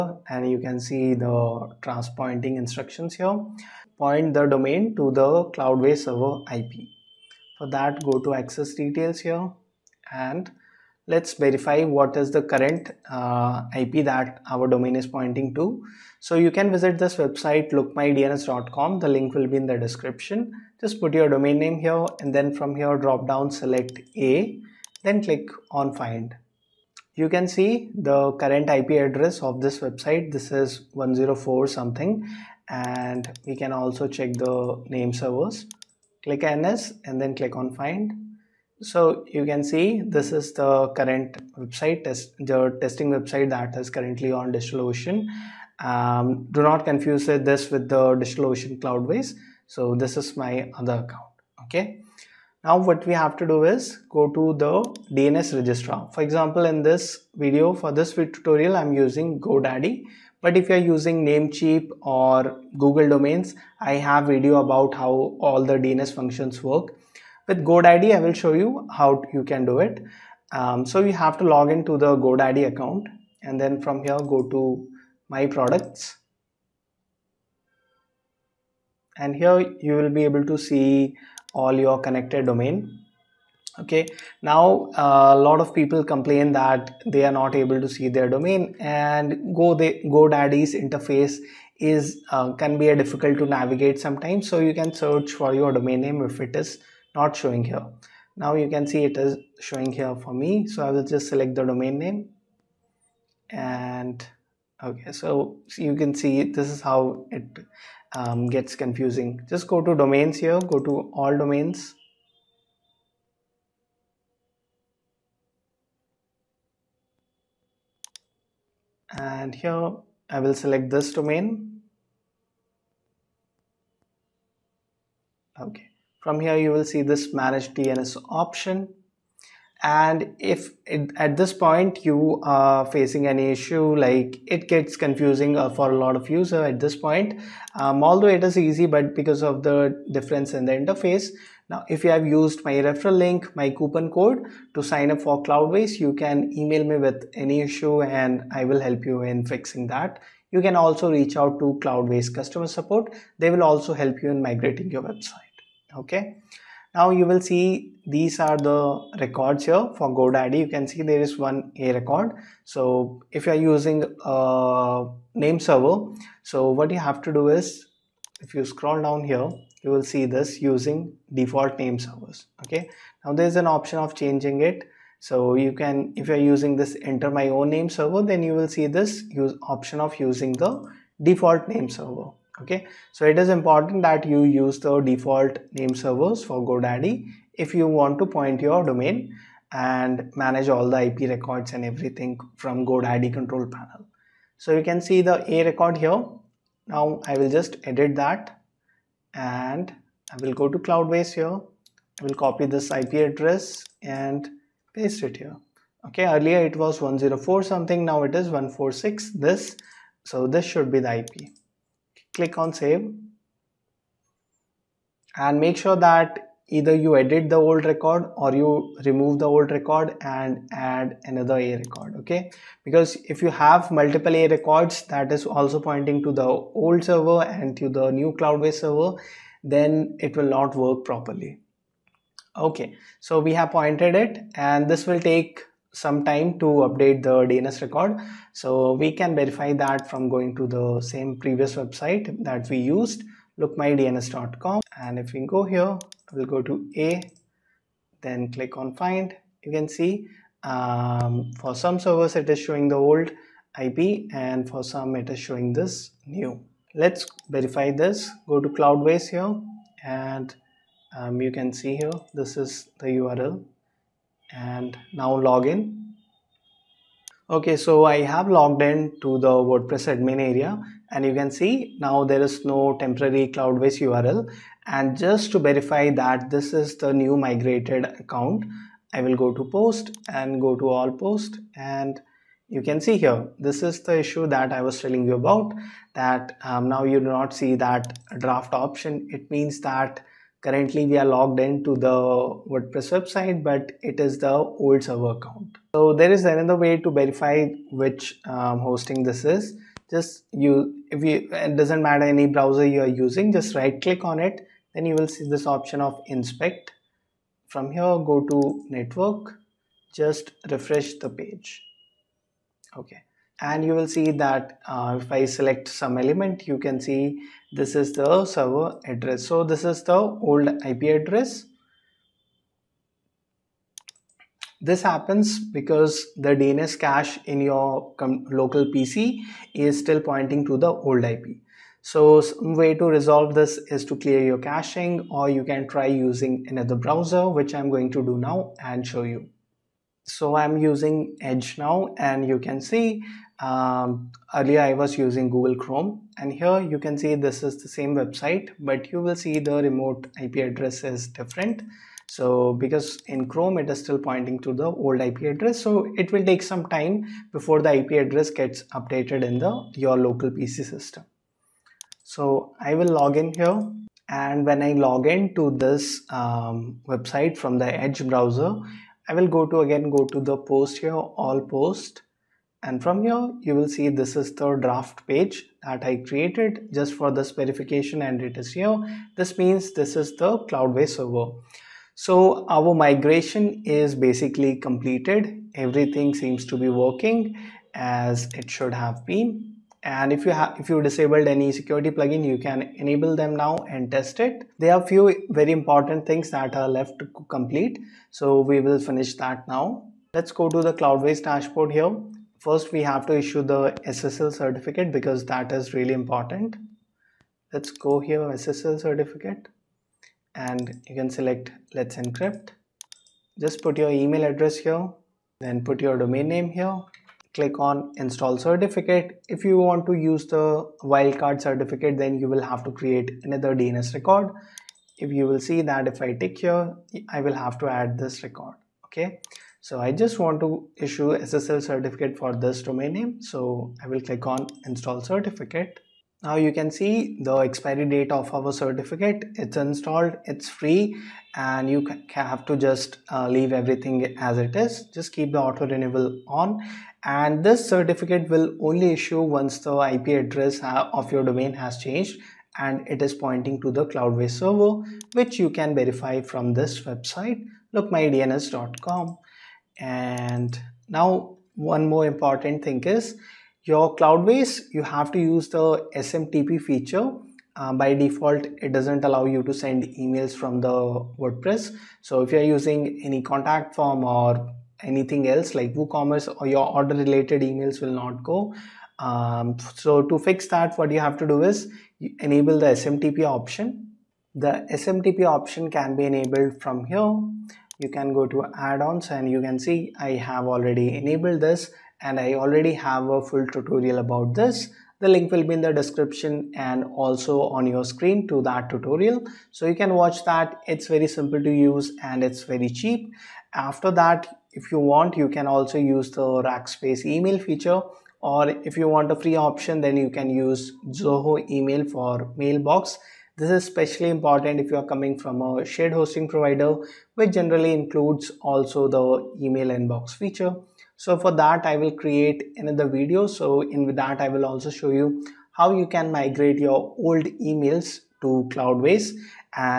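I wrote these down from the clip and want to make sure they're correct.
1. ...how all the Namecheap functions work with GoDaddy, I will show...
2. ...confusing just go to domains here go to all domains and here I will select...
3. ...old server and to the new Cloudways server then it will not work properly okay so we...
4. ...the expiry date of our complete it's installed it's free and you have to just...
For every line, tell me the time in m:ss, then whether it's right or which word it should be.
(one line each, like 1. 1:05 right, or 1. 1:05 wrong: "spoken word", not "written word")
1. 1:04 wrong: "DNS", not "Namecheap"
2. 1:48 right
3. 3:46 right
4. 7:17 wrong: "certificate", not "complete".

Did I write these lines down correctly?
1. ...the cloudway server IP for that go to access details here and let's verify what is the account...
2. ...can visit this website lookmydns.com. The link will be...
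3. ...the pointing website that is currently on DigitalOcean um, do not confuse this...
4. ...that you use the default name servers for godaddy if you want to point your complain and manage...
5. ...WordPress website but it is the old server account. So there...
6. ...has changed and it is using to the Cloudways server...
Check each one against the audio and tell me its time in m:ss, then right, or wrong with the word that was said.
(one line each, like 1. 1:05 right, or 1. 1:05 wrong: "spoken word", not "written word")
1. 0:05 wrong: "current", not "account"
2. 0:16 right
3. 0:42 wrong: "testing", not "pointing"
4. 3:04 wrong: "domain", not "complain"
5. 4:52 right
6. 7:31 wrong: "pointing", not "using".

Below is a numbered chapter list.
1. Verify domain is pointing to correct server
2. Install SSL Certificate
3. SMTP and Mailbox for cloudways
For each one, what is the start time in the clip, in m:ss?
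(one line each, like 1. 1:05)
1. 4:23
2. 6:42
3. 7:58.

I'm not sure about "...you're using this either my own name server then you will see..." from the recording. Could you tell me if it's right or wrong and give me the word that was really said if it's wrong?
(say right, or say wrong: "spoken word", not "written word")
wrong: "enter", not "either".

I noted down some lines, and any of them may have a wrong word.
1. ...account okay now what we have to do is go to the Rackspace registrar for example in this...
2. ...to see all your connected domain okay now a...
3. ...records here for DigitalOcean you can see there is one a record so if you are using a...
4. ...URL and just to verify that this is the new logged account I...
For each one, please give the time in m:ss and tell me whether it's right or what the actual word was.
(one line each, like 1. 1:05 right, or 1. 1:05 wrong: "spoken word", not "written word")
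1. 0:50 wrong: "DNS", not "Rackspace"
2. 1:20 right
3. 2:39 wrong: "GoDaddy", not "DigitalOcean"
4. 4:34 wrong: "migrated", not "logged".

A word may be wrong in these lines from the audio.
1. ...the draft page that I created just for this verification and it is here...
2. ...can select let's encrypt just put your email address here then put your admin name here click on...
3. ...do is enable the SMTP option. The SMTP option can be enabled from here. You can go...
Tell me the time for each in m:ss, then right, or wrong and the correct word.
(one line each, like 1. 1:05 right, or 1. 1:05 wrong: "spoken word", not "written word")
1. 6:14 right
2. 6:51 wrong: "domain", not "admin"
3. 8:01 right.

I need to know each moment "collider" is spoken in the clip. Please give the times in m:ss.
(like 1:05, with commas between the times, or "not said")
not said.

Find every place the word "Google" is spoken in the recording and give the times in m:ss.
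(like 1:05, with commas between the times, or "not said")
1:02, 5:45.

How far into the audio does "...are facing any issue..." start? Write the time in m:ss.
2:12.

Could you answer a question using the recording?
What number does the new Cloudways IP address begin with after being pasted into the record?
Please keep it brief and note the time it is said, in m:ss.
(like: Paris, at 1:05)
146, at 3:28.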